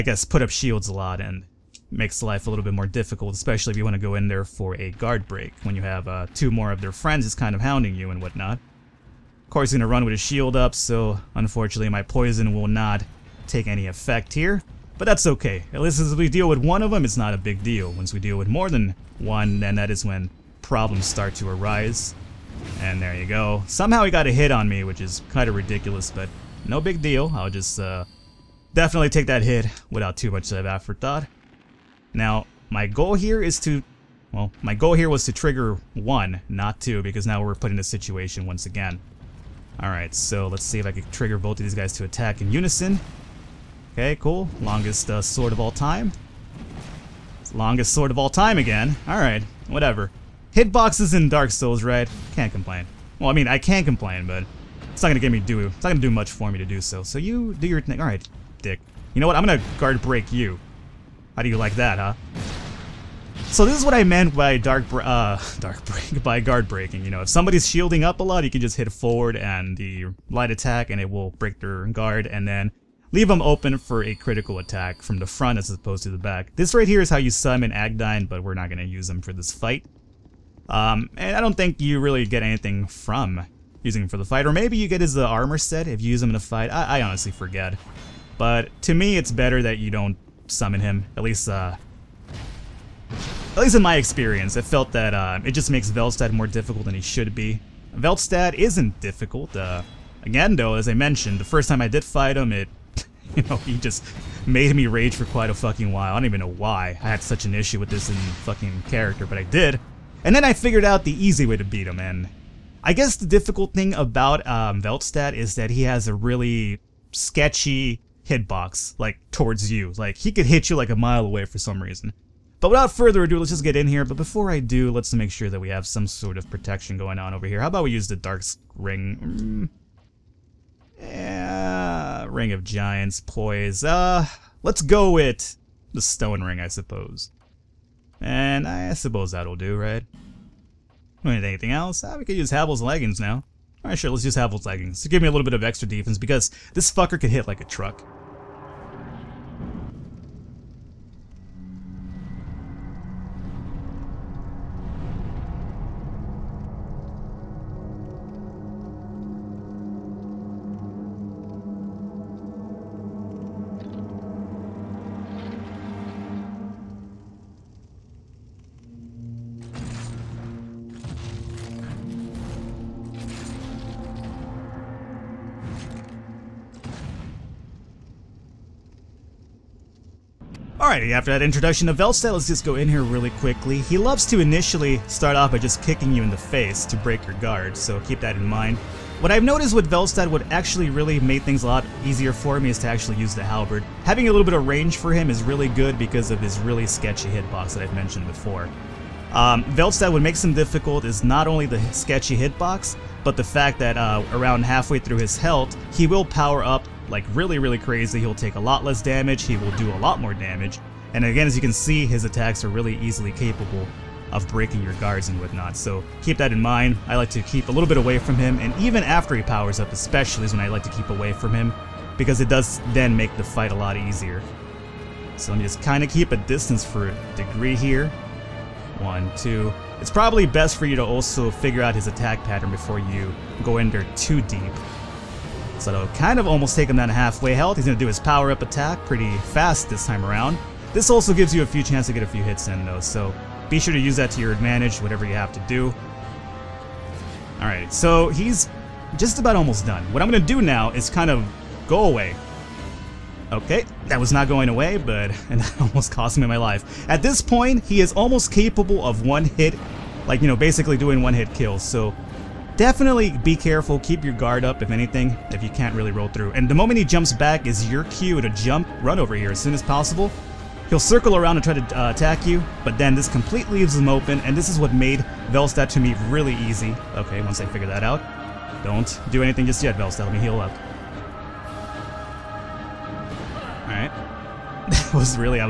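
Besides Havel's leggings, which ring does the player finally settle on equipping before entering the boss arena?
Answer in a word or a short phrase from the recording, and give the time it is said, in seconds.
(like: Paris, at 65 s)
Stone Ring, at 135 s.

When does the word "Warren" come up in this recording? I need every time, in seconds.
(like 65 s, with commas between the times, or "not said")
not said.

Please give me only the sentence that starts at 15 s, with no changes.
At least as we deal with one of them, it's not a big deal.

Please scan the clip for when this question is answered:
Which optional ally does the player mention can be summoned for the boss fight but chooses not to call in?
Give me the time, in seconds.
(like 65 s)
77 s.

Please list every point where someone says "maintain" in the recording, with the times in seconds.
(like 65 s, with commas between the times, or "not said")
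not said.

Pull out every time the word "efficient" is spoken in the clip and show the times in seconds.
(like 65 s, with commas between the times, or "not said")
not said.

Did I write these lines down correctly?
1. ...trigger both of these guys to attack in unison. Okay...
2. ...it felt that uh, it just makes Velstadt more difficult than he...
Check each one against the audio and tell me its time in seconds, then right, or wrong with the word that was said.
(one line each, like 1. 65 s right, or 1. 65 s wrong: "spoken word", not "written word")
1. 41 s right
2. 94 s right.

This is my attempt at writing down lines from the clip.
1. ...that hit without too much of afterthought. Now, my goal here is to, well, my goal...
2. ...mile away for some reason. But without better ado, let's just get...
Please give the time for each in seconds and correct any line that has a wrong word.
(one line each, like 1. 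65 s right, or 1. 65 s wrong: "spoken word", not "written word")
1. 29 s right
2. 120 s wrong: "further", not "better".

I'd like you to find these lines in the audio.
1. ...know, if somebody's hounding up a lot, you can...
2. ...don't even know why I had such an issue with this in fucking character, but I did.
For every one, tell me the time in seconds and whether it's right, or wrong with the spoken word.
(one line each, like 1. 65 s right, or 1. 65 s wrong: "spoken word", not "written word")
1. 67 s wrong: "shielding", not "hounding"
2. 106 s right.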